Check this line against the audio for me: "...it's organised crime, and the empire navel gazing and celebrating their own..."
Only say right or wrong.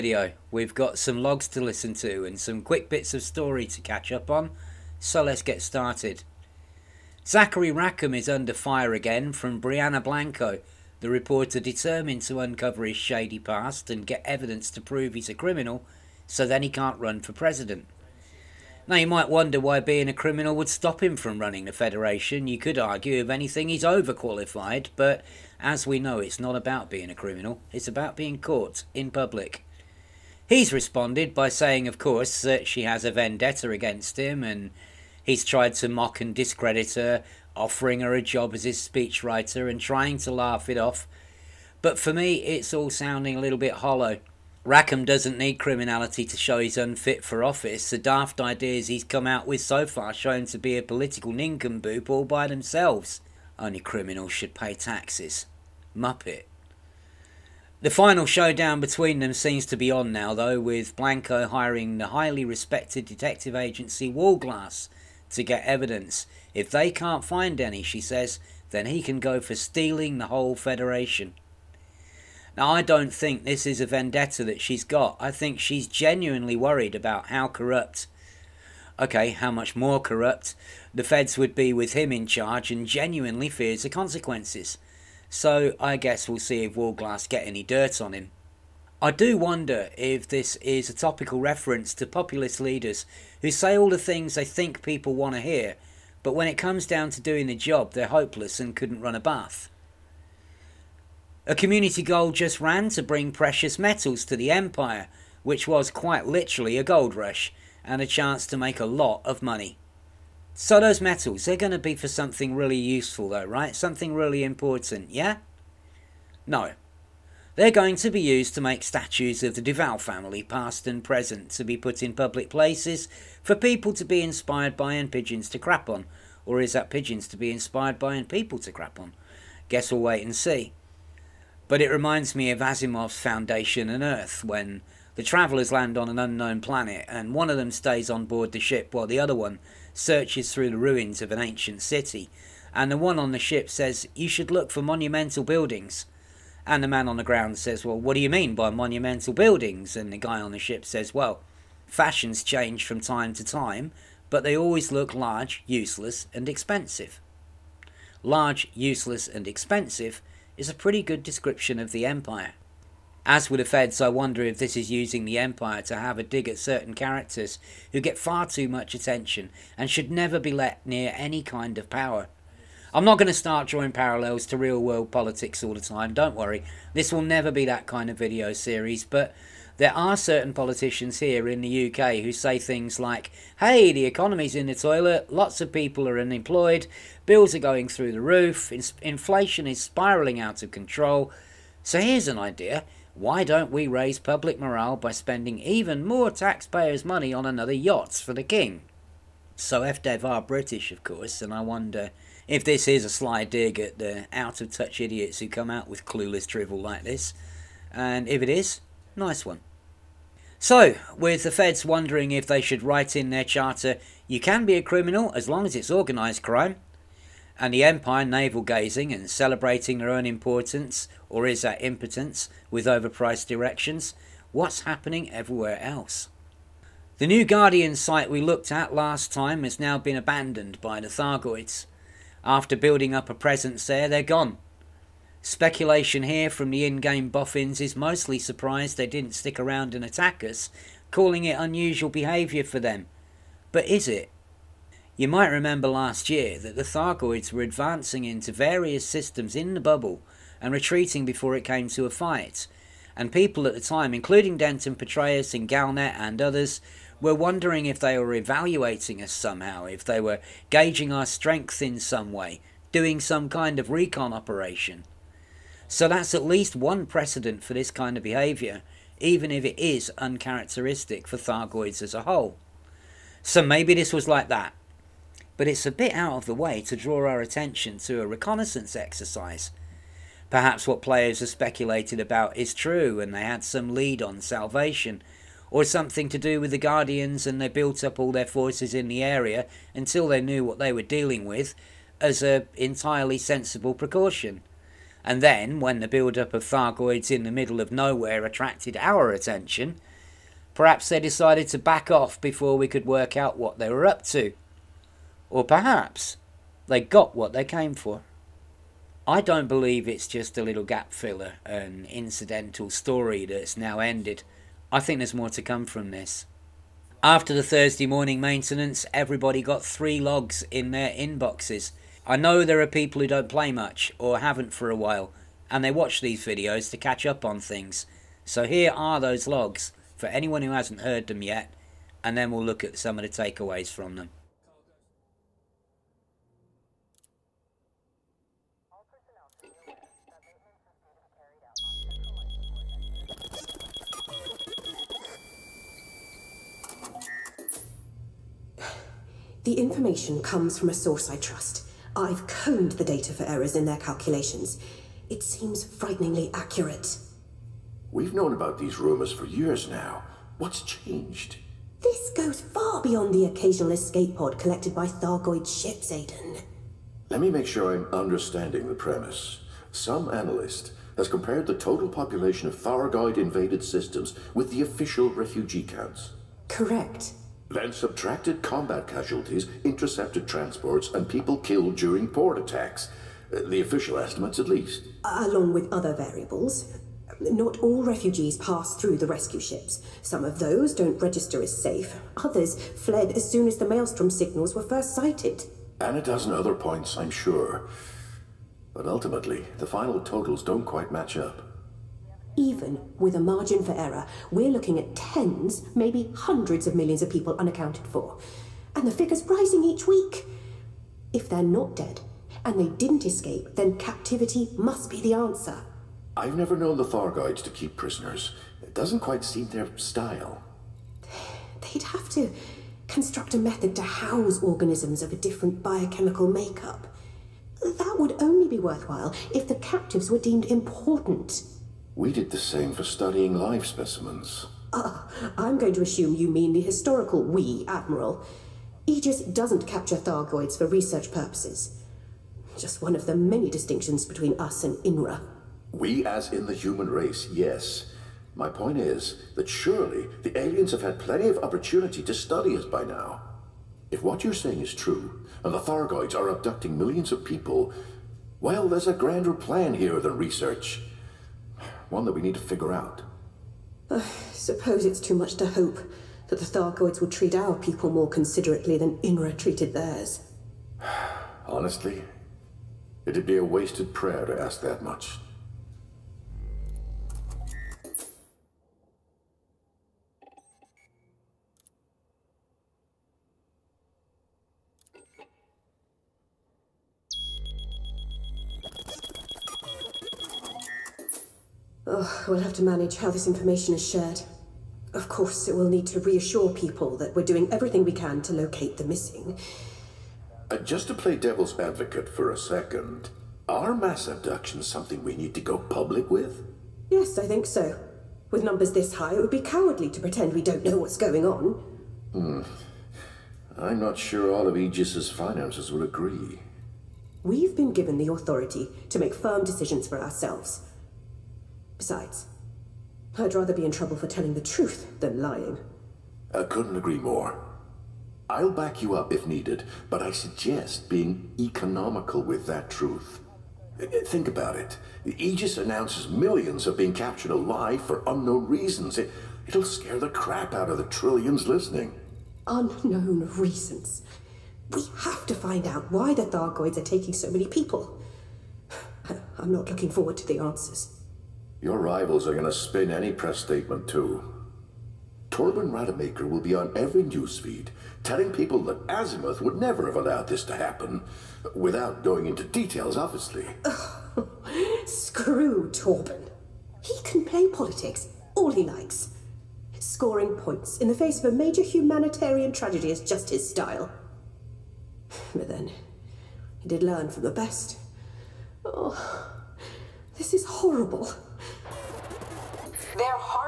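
right.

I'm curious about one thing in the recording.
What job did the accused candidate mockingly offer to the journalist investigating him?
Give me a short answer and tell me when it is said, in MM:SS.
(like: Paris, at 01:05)
Speechwriter, at 00:38.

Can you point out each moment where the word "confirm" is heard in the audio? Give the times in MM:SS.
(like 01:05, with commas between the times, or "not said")
not said.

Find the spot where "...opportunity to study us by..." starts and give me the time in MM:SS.
07:31.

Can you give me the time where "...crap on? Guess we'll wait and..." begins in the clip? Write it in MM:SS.
02:08.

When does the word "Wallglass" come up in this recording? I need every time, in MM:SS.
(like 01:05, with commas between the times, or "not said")
01:04, 01:26.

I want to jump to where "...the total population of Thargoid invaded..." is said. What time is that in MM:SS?
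06:11.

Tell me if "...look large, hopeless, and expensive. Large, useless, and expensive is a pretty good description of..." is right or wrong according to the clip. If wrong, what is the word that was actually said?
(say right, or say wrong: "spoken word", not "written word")
wrong: "useless", not "hopeless".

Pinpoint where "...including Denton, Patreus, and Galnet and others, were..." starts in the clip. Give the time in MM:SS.
04:14.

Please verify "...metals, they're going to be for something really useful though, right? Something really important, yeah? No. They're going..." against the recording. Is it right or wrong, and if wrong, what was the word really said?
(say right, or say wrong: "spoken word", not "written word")
right.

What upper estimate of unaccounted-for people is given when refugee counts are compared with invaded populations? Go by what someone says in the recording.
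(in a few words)
Hundreds of millions.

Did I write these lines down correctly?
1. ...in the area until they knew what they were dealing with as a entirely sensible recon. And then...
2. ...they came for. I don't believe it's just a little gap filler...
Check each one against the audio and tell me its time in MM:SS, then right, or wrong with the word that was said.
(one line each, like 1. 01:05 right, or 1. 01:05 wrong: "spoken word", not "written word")
1. 04:48 wrong: "precaution", not "recon"
2. 05:07 right.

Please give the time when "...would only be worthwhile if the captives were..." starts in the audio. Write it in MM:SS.
07:08.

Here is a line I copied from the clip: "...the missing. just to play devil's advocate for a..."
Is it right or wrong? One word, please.
right.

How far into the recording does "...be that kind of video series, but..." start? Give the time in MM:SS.
02:57.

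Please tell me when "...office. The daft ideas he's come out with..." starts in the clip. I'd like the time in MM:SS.
00:47.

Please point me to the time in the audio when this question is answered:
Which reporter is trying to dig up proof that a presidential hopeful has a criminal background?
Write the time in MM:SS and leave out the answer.
00:09.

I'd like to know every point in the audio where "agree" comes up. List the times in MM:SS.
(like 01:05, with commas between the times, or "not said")
08:36, 08:46.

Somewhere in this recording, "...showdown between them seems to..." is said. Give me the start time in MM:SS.
00:58.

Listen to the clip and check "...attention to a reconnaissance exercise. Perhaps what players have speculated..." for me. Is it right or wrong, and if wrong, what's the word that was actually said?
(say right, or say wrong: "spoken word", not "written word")
right.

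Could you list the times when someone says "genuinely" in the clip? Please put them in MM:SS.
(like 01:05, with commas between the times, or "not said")
01:15, 01:22.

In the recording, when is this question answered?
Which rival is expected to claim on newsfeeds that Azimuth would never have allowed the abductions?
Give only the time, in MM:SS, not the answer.
09:15.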